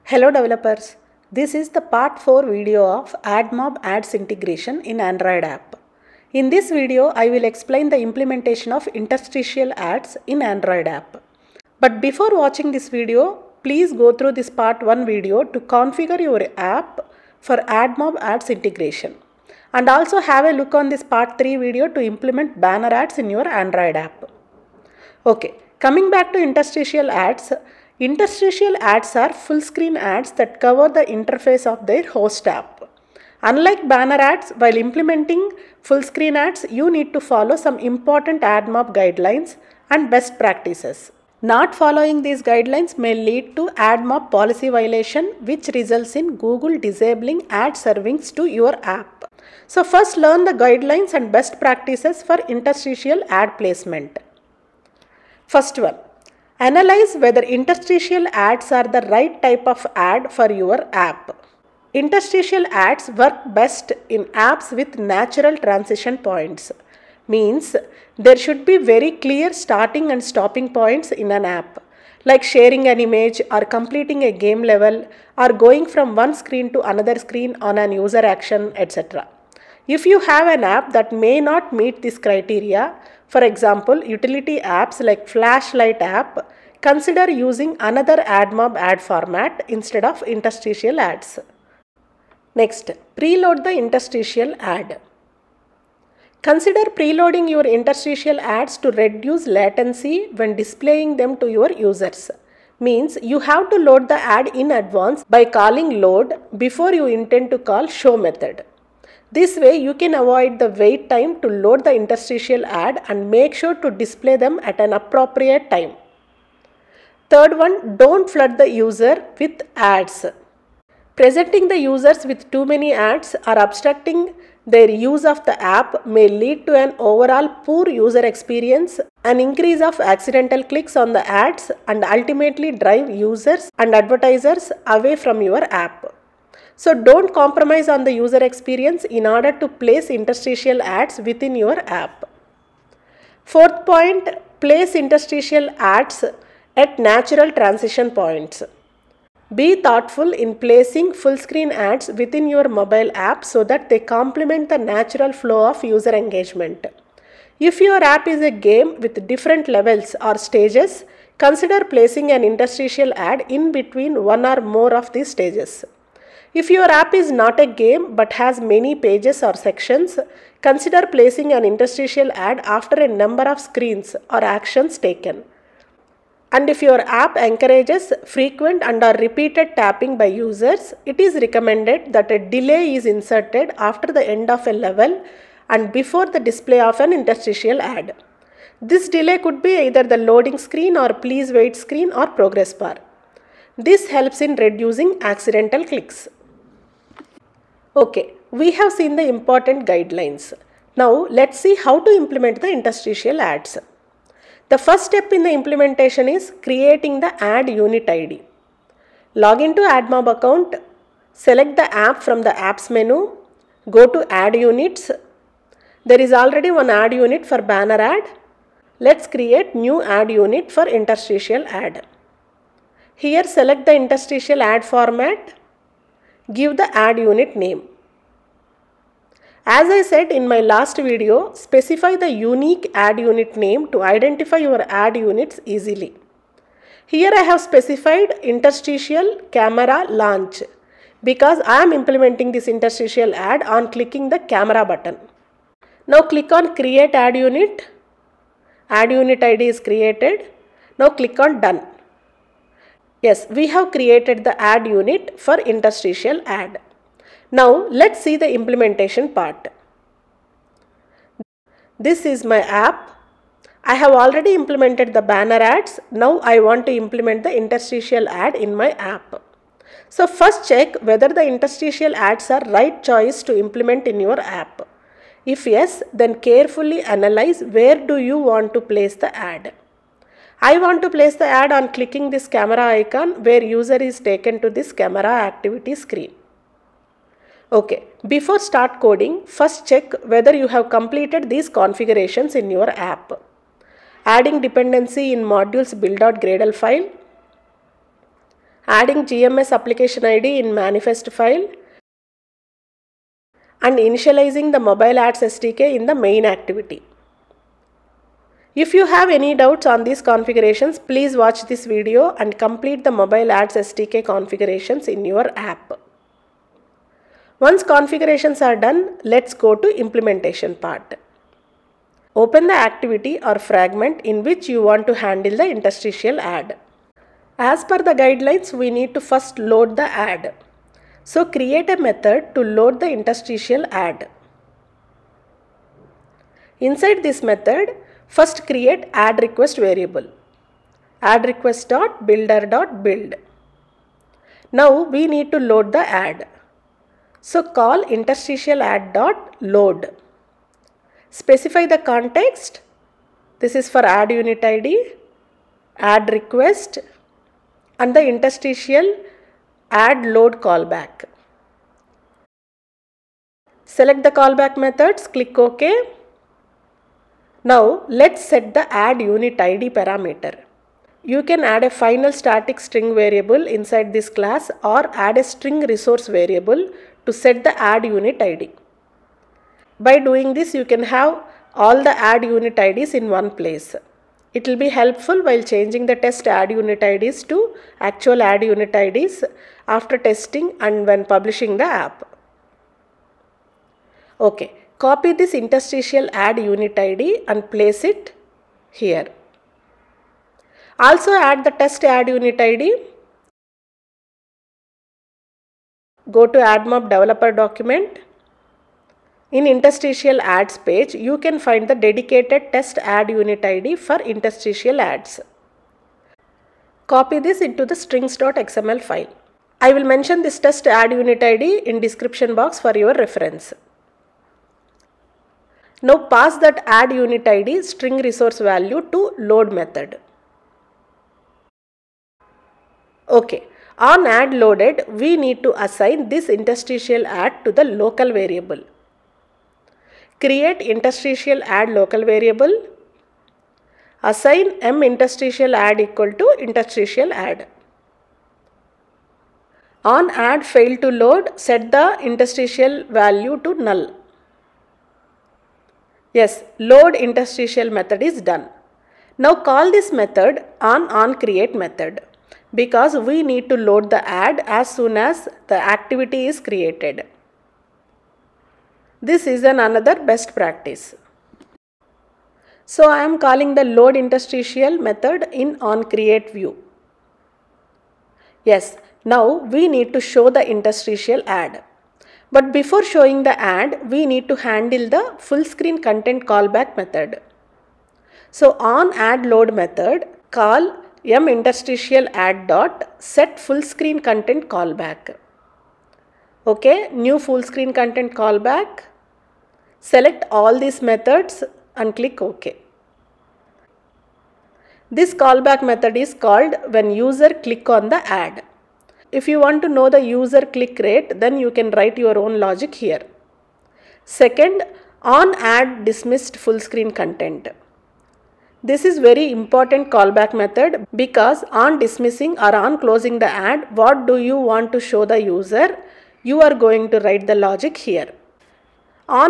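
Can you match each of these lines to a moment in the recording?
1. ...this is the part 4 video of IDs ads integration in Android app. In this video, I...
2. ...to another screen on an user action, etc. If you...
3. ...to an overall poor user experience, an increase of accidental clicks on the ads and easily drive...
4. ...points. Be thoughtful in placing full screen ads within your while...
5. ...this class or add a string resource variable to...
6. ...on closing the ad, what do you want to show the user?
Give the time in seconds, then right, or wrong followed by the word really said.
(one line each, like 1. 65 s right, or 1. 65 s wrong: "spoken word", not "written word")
1. 1 s wrong: "AdMob", not "IDs"
2. 76 s right
3. 126 s wrong: "ultimately", not "easily"
4. 148 s wrong: "mobile", not "while"
5. 374 s right
6. 522 s right.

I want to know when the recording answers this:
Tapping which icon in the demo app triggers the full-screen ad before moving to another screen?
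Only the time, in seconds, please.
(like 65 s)
282 s.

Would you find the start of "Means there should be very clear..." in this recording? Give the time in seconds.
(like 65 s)
67 s.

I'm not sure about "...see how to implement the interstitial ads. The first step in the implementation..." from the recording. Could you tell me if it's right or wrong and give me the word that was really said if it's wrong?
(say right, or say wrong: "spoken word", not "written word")
right.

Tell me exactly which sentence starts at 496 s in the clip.
Okay, new full screen content callback.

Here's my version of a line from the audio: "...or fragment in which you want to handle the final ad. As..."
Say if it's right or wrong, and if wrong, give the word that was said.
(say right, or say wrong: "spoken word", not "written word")
wrong: "interstitial", not "final".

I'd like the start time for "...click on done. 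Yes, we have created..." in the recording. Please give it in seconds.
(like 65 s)
251 s.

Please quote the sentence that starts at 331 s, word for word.
So create a method to load the interstitial ad.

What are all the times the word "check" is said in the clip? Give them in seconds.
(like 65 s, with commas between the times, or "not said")
270 s, 289 s.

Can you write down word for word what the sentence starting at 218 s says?
Let's create new ad unit for interstitial ad.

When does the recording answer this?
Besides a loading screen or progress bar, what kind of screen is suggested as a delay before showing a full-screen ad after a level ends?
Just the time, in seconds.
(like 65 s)
191 s.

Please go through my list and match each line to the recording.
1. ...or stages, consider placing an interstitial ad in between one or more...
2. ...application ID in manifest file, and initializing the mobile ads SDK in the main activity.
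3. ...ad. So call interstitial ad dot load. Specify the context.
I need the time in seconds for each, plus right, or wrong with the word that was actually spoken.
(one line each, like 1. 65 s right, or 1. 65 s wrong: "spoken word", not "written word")
1. 160 s right
2. 299 s right
3. 346 s right.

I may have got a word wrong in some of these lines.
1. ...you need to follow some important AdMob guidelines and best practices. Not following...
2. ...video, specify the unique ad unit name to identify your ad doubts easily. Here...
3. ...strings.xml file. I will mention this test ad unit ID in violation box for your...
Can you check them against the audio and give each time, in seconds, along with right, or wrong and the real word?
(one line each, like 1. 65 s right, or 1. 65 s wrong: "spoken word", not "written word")
1. 36 s right
2. 230 s wrong: "units", not "doubts"
3. 417 s wrong: "description", not "violation".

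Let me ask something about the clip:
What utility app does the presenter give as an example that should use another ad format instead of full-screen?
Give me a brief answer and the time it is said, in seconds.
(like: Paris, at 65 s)
Flashlight app, at 85 s.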